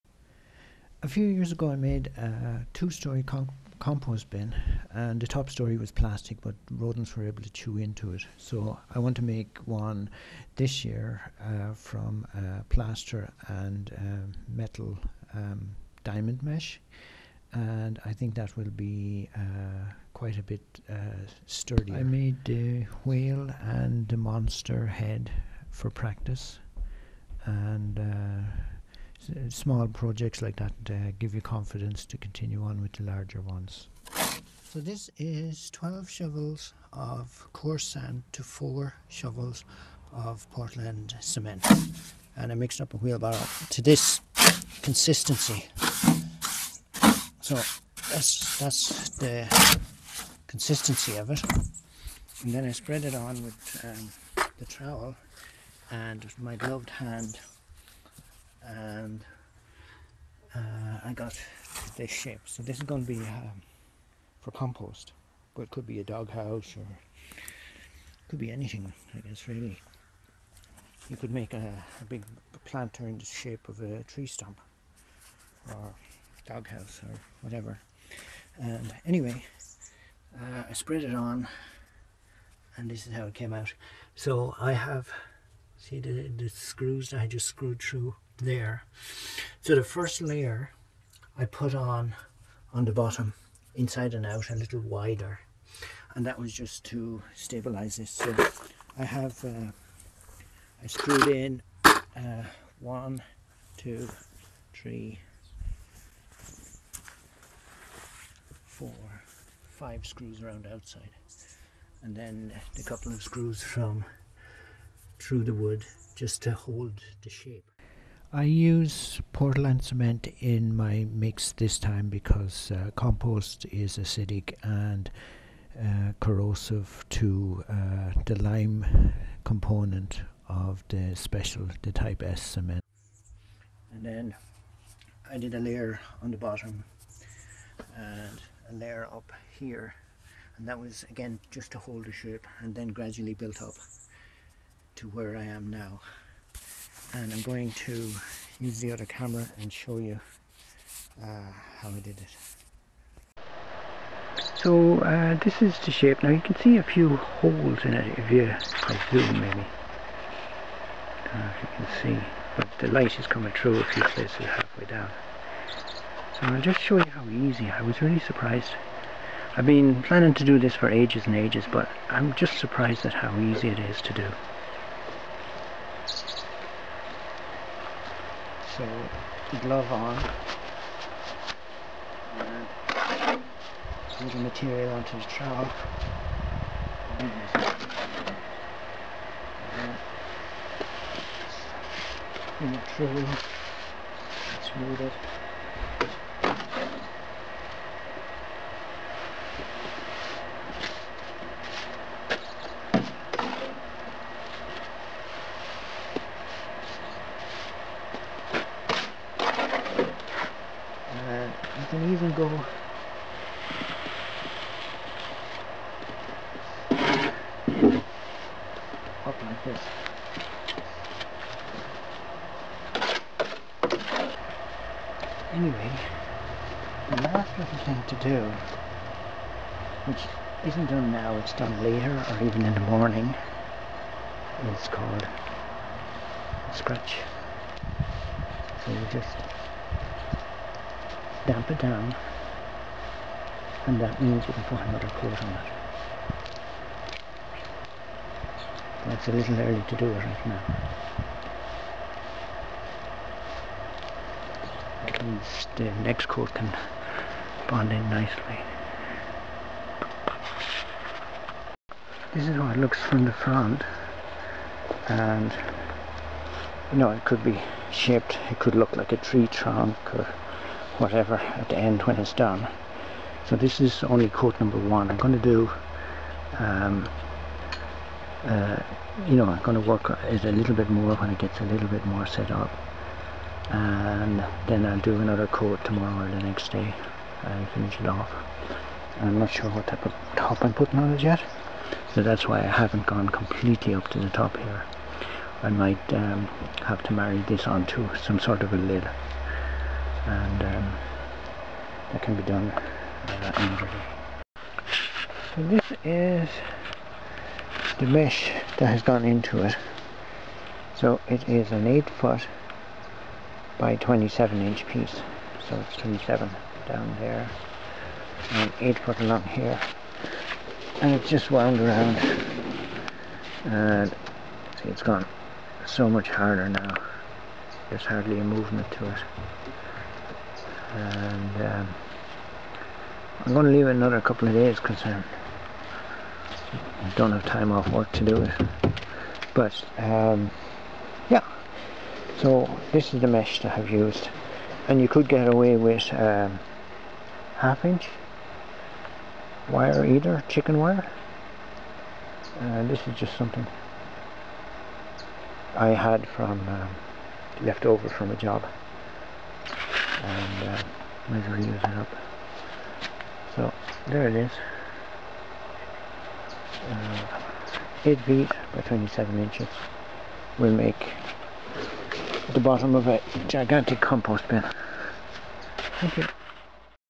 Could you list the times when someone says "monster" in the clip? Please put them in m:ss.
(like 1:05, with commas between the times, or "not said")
0:24.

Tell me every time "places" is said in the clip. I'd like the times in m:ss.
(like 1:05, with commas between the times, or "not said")
2:44.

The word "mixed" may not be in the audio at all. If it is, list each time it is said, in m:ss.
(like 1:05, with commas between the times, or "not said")
0:42.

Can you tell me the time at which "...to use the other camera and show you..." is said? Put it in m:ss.
2:27.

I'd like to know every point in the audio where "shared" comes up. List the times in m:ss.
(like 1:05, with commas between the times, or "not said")
not said.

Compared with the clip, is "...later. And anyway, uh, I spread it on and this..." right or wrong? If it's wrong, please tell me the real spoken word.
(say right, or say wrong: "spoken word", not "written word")
wrong: "whatever", not "later".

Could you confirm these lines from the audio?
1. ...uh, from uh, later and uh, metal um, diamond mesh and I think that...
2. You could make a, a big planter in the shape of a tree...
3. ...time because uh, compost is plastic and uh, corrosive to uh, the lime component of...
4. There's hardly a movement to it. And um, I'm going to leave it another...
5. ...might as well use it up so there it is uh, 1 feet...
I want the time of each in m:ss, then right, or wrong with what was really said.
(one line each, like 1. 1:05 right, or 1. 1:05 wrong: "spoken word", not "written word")
1. 0:11 wrong: "plaster", not "later"
2. 1:11 right
3. 2:01 wrong: "acidic", not "plastic"
4. 5:27 right
5. 6:01 wrong: "8", not "1".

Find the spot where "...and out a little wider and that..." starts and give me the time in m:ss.
1:34.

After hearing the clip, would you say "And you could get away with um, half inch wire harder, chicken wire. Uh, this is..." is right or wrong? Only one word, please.
wrong.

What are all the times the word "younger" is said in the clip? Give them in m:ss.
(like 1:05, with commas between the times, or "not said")
not said.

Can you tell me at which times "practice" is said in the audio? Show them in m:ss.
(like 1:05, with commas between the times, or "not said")
0:25.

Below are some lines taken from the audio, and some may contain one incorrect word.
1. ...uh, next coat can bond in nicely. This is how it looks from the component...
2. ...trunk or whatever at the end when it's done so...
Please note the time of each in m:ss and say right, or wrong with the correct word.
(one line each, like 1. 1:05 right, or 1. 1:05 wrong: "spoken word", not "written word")
1. 4:15 wrong: "front", not "component"
2. 4:29 right.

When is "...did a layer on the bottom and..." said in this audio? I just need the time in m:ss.
2:15.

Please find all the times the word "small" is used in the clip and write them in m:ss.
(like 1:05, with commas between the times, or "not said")
0:29.